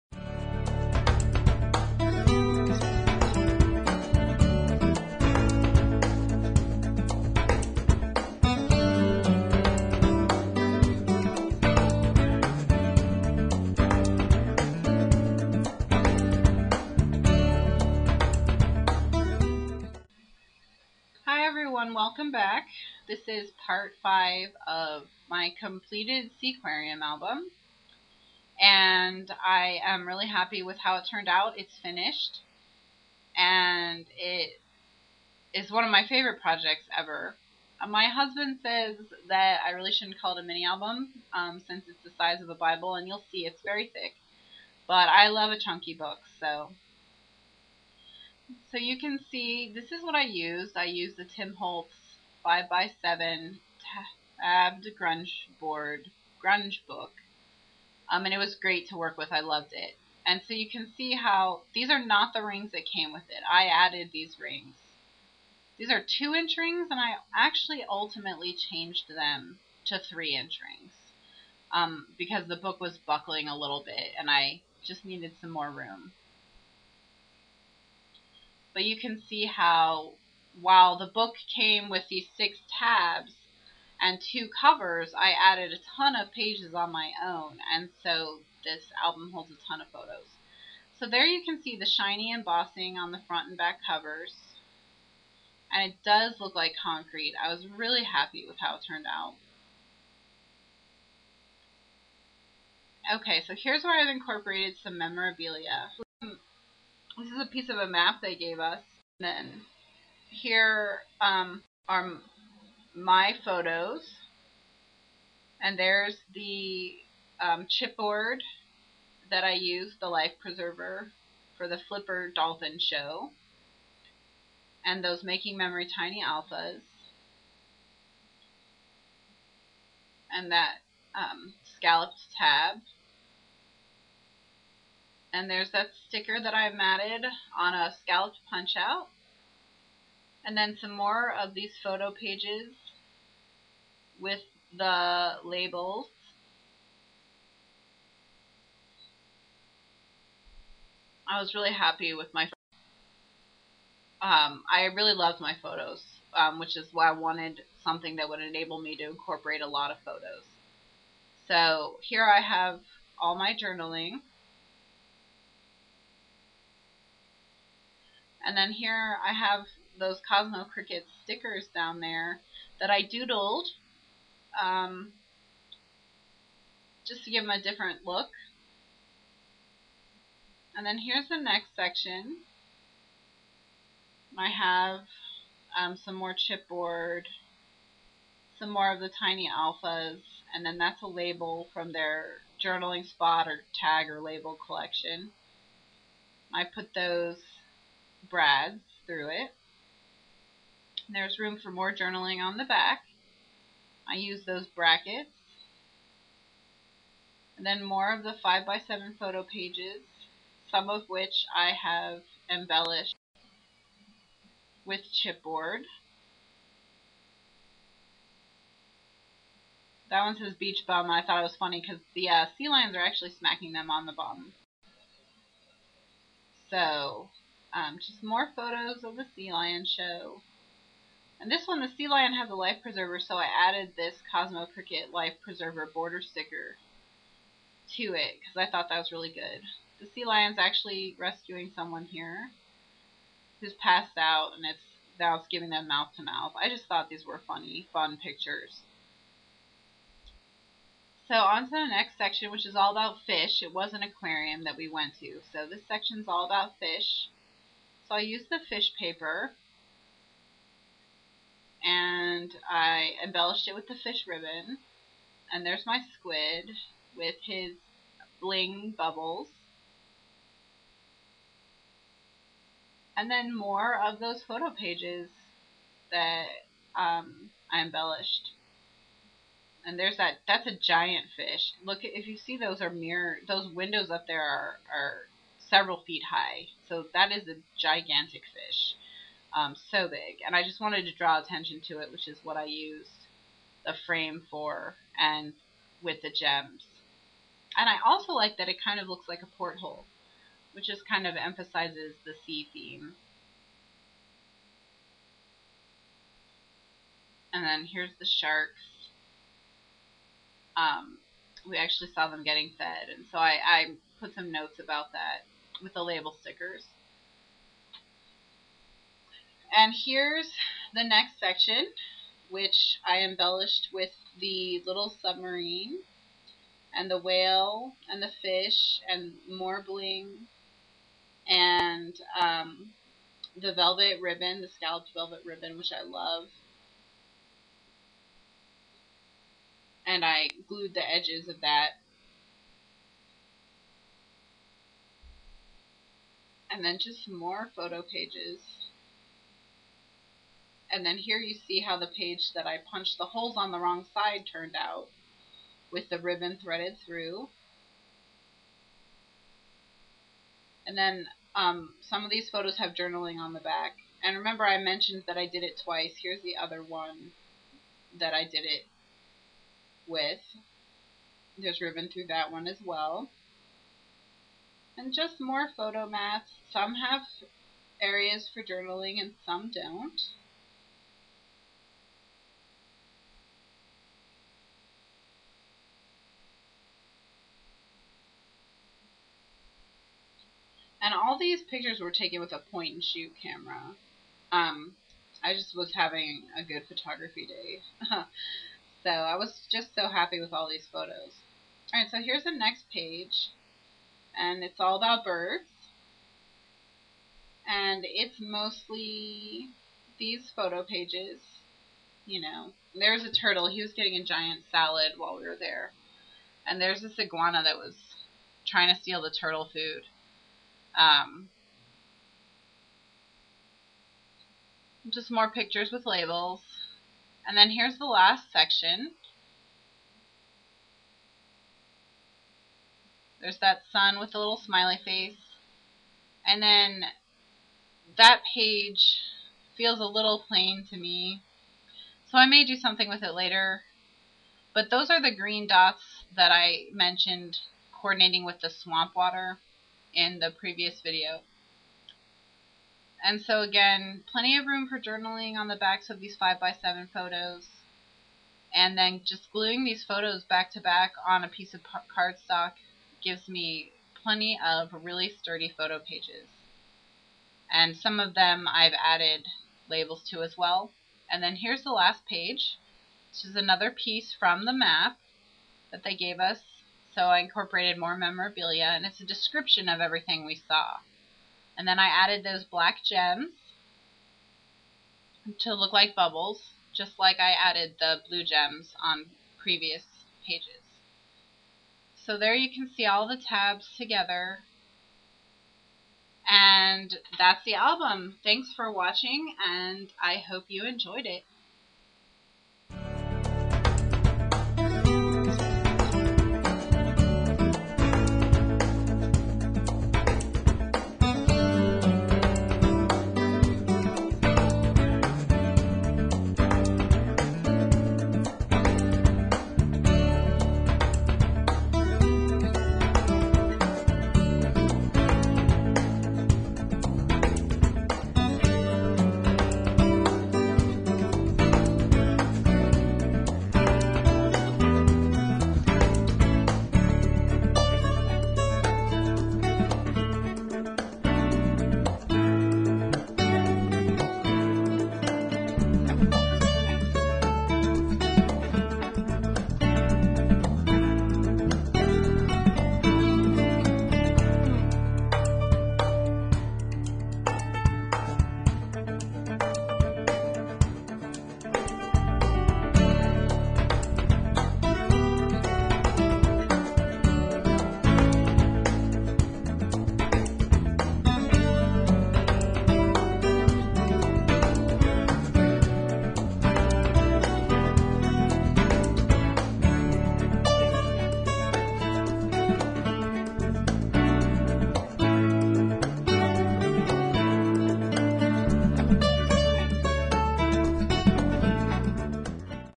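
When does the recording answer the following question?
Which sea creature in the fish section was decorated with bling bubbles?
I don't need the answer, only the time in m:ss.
4:26.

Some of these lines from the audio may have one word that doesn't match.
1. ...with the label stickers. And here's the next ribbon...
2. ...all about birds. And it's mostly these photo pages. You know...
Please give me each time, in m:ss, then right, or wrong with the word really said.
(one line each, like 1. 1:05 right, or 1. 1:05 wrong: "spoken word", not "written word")
1. 5:15 wrong: "section", not "ribbon"
2. 6:44 right.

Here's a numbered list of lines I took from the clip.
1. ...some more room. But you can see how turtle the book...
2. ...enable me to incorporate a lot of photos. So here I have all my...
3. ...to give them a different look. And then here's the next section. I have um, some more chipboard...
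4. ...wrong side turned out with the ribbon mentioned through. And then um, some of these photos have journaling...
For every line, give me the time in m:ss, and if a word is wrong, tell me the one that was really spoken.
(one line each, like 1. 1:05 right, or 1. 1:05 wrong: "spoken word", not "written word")
1. 1:15 wrong: "while", not "turtle"
2. 2:38 right
3. 2:57 right
4. 5:53 wrong: "threaded", not "mentioned".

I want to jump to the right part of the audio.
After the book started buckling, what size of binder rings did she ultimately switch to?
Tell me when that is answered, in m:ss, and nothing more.
1:09.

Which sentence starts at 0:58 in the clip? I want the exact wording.
Um, and it was great to work with.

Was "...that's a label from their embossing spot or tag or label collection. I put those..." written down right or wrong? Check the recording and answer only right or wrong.
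wrong.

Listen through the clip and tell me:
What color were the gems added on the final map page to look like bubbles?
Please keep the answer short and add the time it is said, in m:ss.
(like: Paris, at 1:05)
black, at 8:02.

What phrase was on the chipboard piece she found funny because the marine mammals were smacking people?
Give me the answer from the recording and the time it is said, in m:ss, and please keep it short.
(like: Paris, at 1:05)
beach bum, at 3:40.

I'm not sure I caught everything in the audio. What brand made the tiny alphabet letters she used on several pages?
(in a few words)
Making Memories.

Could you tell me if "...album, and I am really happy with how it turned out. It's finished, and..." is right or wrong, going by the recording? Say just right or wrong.
right.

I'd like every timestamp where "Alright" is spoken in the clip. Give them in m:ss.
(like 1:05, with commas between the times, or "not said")
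6:41.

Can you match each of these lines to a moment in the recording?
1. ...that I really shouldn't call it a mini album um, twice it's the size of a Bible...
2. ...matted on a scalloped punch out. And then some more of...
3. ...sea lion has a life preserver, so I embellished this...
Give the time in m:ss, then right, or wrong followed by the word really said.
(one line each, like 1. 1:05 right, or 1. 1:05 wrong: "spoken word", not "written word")
1. 0:39 wrong: "since", not "twice"
2. 2:16 right
3. 3:51 wrong: "added", not "embellished".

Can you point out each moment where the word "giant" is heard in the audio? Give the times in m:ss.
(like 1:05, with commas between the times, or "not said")
4:40, 6:54.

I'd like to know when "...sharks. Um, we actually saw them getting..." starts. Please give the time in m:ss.
5:08.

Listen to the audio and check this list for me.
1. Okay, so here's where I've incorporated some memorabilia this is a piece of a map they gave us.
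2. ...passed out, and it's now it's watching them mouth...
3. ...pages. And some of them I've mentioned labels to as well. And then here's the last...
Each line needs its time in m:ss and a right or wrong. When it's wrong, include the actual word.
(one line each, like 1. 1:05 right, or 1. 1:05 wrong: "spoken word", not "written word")
1. 1:43 right
2. 4:03 wrong: "giving", not "watching"
3. 7:45 wrong: "added", not "mentioned".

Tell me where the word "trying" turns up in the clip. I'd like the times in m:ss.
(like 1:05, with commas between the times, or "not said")
6:58.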